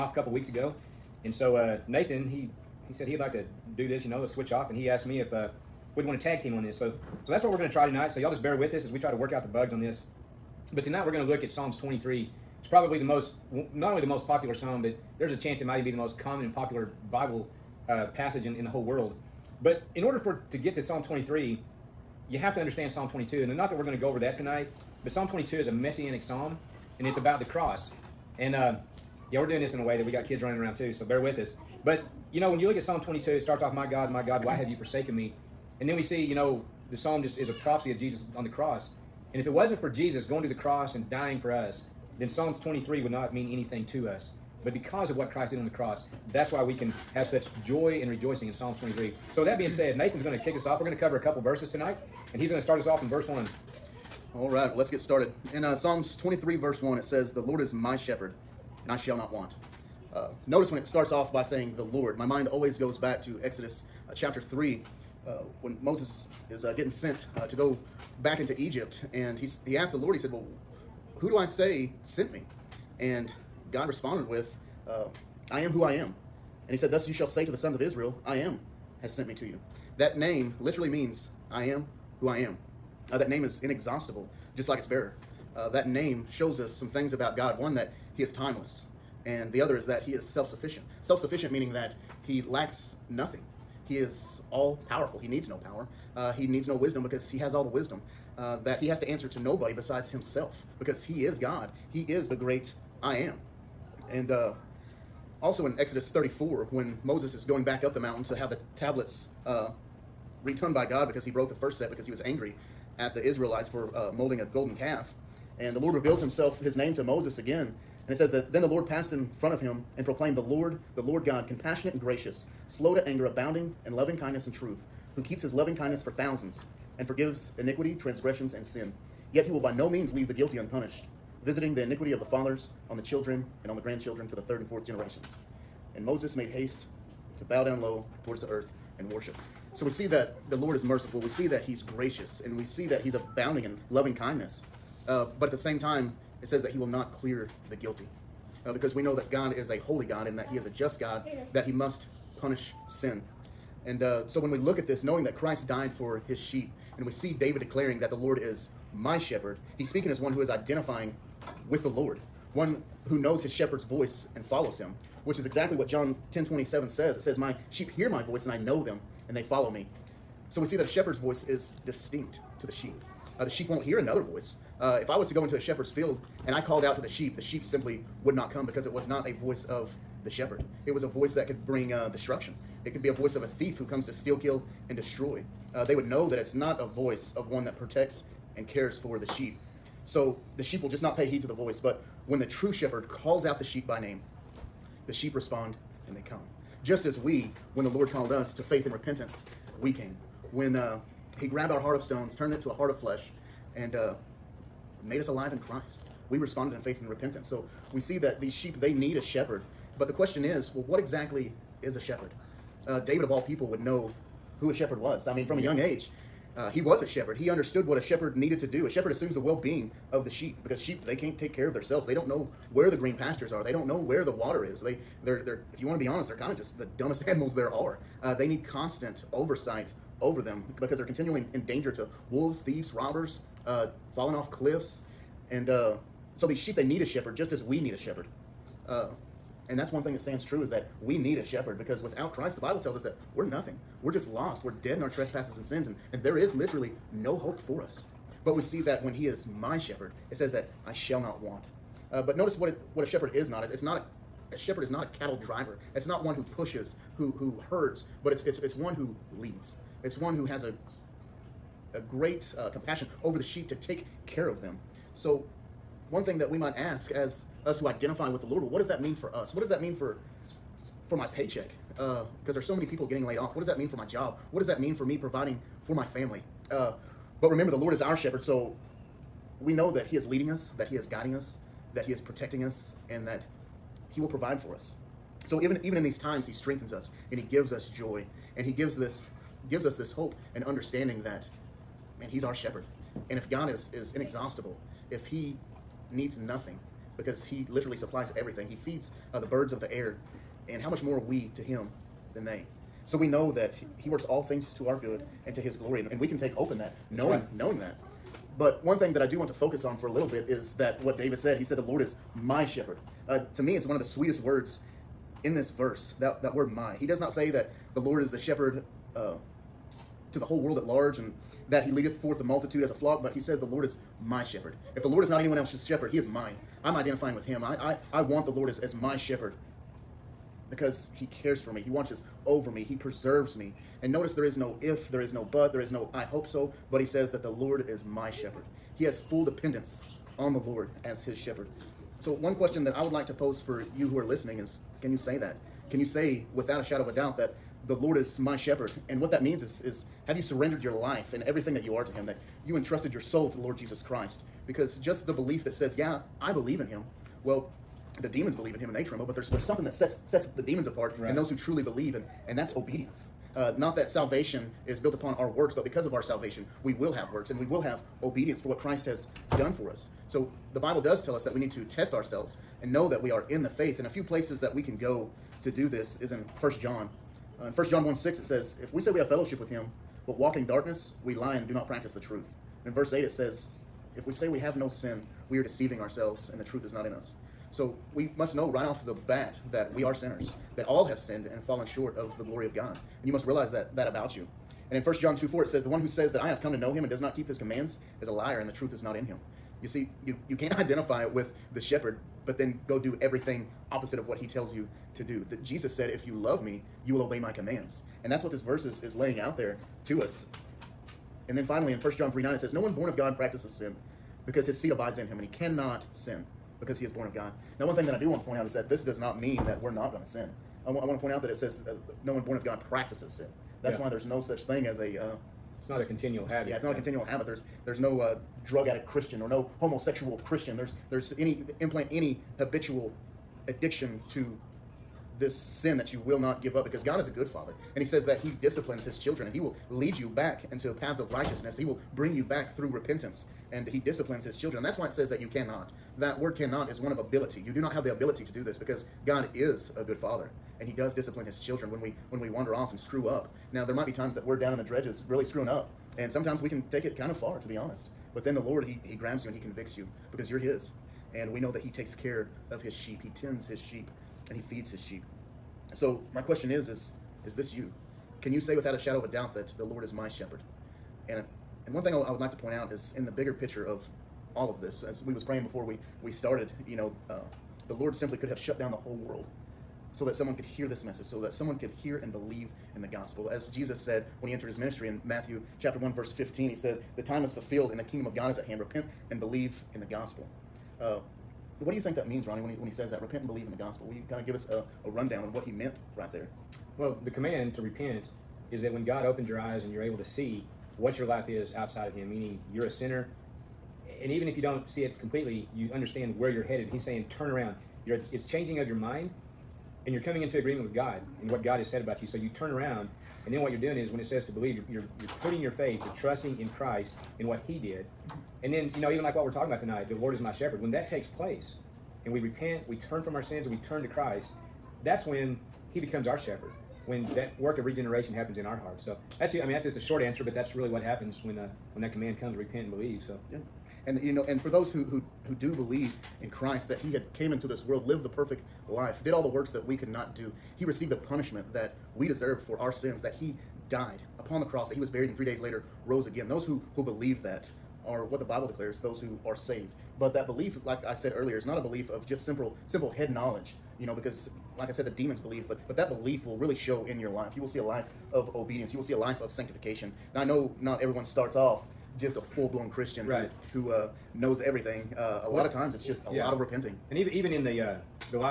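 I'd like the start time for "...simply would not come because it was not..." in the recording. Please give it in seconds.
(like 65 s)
177 s.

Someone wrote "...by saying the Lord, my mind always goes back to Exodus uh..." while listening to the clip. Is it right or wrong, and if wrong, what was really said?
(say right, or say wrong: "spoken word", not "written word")
right.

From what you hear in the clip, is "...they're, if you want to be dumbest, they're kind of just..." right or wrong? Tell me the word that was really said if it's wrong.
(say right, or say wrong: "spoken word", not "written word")
wrong: "honest", not "dumbest".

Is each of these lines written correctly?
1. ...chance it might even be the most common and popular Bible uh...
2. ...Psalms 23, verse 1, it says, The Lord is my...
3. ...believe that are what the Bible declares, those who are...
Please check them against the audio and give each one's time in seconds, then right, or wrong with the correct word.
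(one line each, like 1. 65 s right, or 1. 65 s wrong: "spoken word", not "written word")
1. 15 s right
2. 55 s right
3. 547 s right.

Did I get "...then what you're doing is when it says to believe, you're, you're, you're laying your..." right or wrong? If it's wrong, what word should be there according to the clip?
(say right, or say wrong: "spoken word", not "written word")
wrong: "putting", not "laying".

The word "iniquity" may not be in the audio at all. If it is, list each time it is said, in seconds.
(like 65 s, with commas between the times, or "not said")
127 s, 131 s.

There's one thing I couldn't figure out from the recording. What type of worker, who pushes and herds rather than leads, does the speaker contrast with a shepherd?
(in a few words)
A cattle driver.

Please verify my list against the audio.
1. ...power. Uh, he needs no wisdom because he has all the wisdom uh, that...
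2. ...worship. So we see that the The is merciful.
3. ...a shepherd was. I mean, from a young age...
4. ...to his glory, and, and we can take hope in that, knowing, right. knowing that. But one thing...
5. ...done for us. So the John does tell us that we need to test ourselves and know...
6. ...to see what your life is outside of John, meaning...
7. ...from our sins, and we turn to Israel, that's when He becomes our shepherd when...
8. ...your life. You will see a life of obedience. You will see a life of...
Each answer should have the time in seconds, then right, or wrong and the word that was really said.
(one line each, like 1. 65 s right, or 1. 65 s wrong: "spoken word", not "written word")
1. 95 s right
2. 139 s wrong: "Lord", not "The"
3. 214 s right
4. 305 s right
5. 369 s wrong: "Bible", not "John"
6. 500 s wrong: "Him", not "John"
7. 523 s wrong: "Christ", not "Israel"
8. 557 s right.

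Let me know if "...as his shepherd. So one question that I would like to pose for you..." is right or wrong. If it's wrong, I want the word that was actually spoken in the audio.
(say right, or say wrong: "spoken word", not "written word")
right.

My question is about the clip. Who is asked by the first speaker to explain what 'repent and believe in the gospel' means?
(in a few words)
Ronnie.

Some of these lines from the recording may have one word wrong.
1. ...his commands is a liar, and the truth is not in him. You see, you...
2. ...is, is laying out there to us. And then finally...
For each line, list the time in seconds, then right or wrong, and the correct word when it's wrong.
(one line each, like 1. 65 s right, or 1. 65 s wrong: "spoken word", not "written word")
1. 397 s right
2. 408 s right.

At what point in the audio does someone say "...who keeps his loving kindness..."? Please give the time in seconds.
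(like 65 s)
125 s.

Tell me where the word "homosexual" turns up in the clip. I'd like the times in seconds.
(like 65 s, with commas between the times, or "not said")
429 s.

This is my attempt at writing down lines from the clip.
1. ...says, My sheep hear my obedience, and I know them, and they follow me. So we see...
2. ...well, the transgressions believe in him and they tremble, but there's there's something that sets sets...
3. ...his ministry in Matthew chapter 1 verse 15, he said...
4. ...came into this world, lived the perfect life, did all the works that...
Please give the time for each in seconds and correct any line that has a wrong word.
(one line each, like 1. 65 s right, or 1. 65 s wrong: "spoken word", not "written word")
1. 167 s wrong: "voice", not "obedience"
2. 357 s wrong: "demons", not "transgressions"
3. 484 s right
4. 537 s right.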